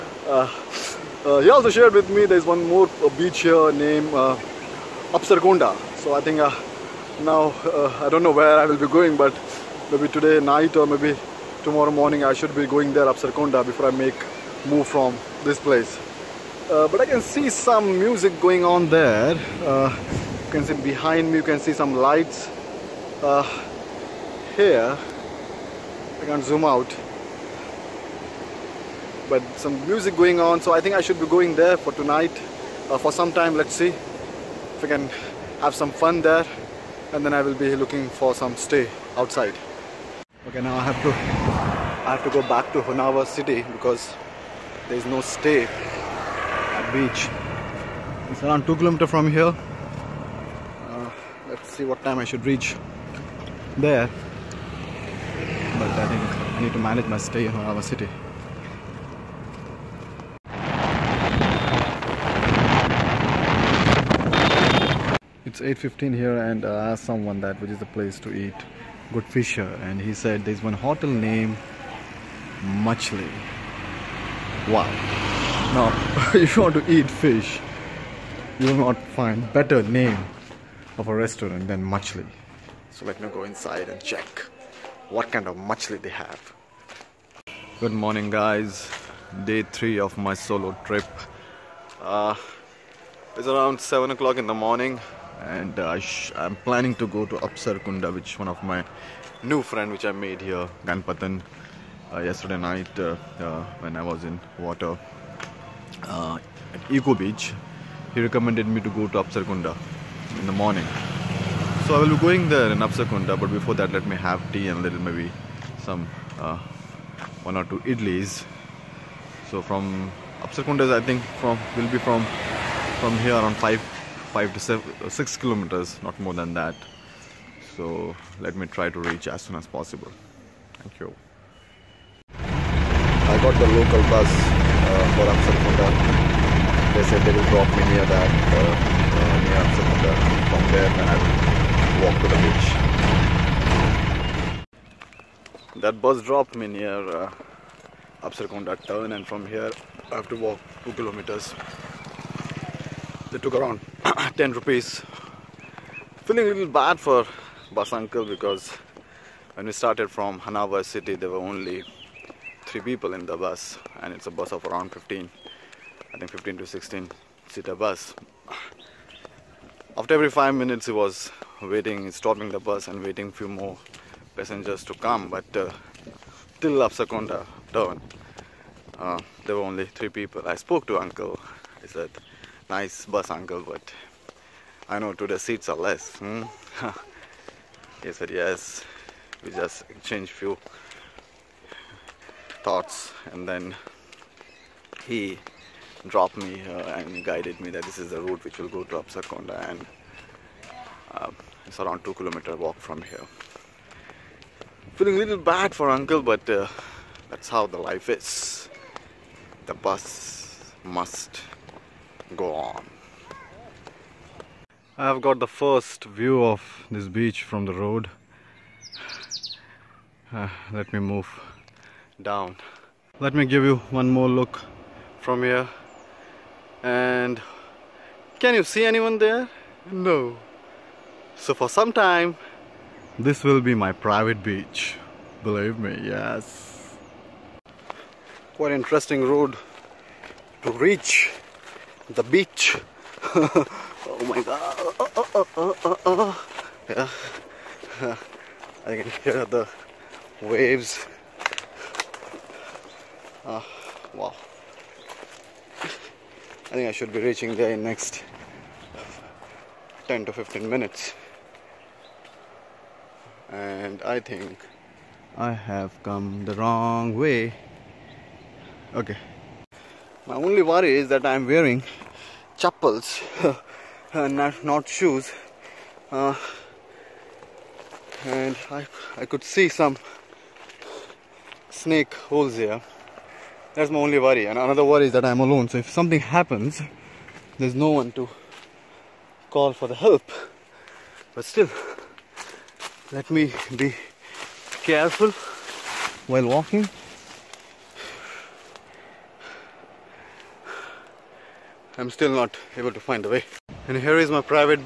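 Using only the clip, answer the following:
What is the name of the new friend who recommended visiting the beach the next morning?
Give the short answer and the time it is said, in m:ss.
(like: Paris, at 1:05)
Ganpatan, at 1:40.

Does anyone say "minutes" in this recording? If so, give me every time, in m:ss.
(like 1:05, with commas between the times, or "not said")
2:50, 4:20.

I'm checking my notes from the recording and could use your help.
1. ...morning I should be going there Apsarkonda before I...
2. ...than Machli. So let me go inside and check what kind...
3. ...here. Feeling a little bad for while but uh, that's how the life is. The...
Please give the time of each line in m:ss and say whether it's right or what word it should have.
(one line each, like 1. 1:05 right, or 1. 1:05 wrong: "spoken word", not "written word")
1. 0:11 right
2. 1:21 right
3. 3:23 wrong: "uncle", not "while".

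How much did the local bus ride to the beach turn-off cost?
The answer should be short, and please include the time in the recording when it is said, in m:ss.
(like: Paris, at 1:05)
10 rupees, at 2:34.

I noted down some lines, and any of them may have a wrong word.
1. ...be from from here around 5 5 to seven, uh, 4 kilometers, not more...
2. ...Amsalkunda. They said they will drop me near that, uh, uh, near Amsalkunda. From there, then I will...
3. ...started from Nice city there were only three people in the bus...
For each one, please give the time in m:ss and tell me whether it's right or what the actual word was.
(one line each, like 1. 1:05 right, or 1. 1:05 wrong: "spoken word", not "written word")
1. 2:01 wrong: "6", not "4"
2. 2:15 right
3. 2:39 wrong: "Hanawa", not "Nice".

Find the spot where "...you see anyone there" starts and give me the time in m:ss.
3:48.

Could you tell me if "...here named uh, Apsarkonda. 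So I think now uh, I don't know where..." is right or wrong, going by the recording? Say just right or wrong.
right.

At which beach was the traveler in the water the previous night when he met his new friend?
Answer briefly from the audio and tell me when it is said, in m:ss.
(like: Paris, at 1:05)
Eco Beach, at 1:46.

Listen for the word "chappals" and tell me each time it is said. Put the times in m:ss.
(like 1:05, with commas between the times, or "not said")
4:32.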